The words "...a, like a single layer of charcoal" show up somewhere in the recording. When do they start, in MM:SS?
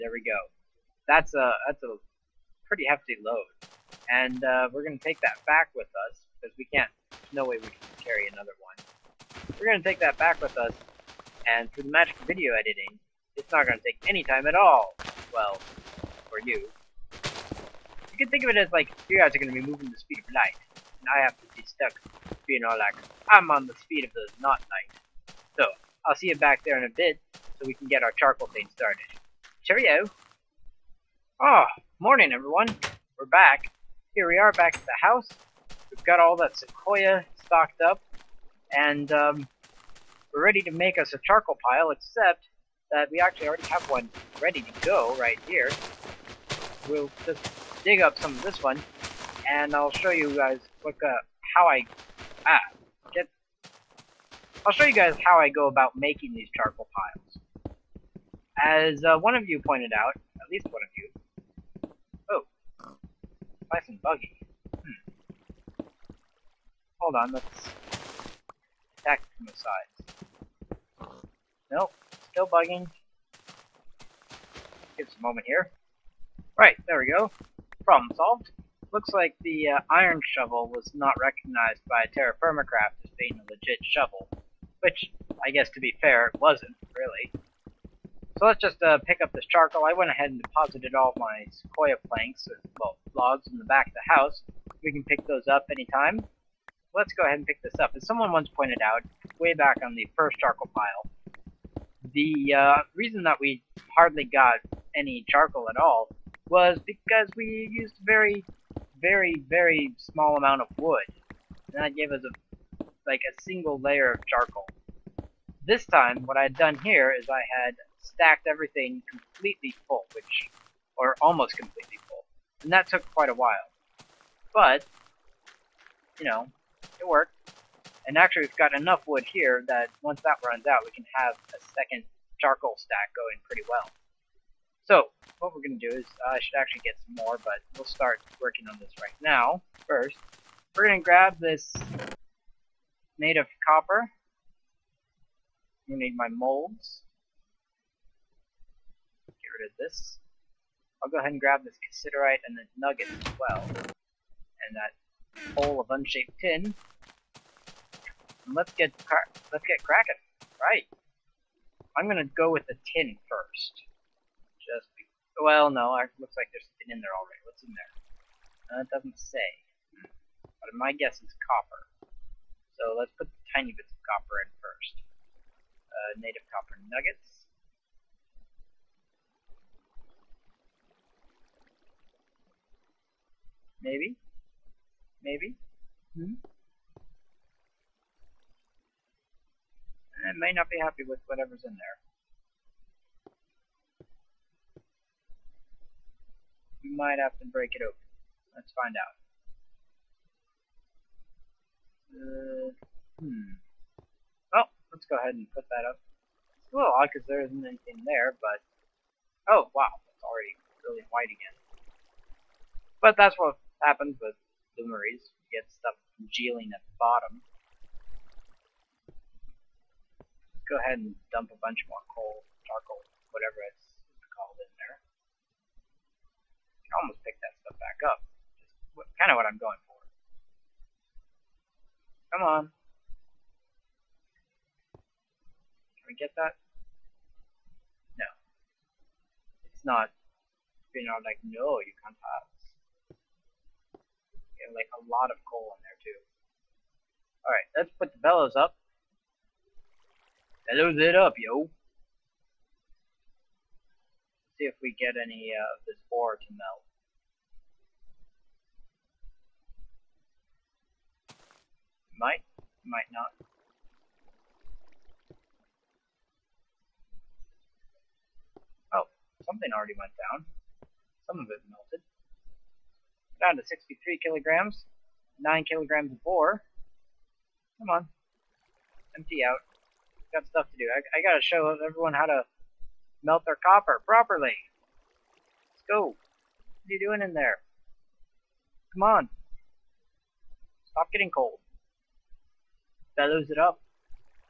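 01:52.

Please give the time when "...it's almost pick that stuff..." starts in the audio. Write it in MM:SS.
03:43.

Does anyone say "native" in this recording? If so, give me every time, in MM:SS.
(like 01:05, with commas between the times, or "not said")
02:23, 02:56.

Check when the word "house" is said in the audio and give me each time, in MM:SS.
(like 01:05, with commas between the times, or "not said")
00:35, 01:34.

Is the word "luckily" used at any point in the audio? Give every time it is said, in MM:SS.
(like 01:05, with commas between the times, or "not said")
not said.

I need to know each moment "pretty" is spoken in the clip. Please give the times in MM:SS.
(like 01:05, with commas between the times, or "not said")
00:02, 02:13.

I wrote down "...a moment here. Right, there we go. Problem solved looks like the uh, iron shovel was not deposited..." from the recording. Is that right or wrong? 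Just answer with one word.
wrong.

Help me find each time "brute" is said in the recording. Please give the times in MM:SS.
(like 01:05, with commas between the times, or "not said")
not said.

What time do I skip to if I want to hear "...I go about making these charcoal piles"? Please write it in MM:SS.
00:55.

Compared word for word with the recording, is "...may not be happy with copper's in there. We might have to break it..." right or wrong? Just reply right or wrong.
wrong.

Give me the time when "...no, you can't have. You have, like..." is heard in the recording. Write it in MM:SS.
04:01.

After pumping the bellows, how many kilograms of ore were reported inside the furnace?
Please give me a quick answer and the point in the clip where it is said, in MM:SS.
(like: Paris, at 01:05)
9 kilograms, at 04:35.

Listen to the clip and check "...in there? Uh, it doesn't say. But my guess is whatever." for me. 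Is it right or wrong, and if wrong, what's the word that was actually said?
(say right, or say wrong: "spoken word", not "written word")
wrong: "copper", not "whatever".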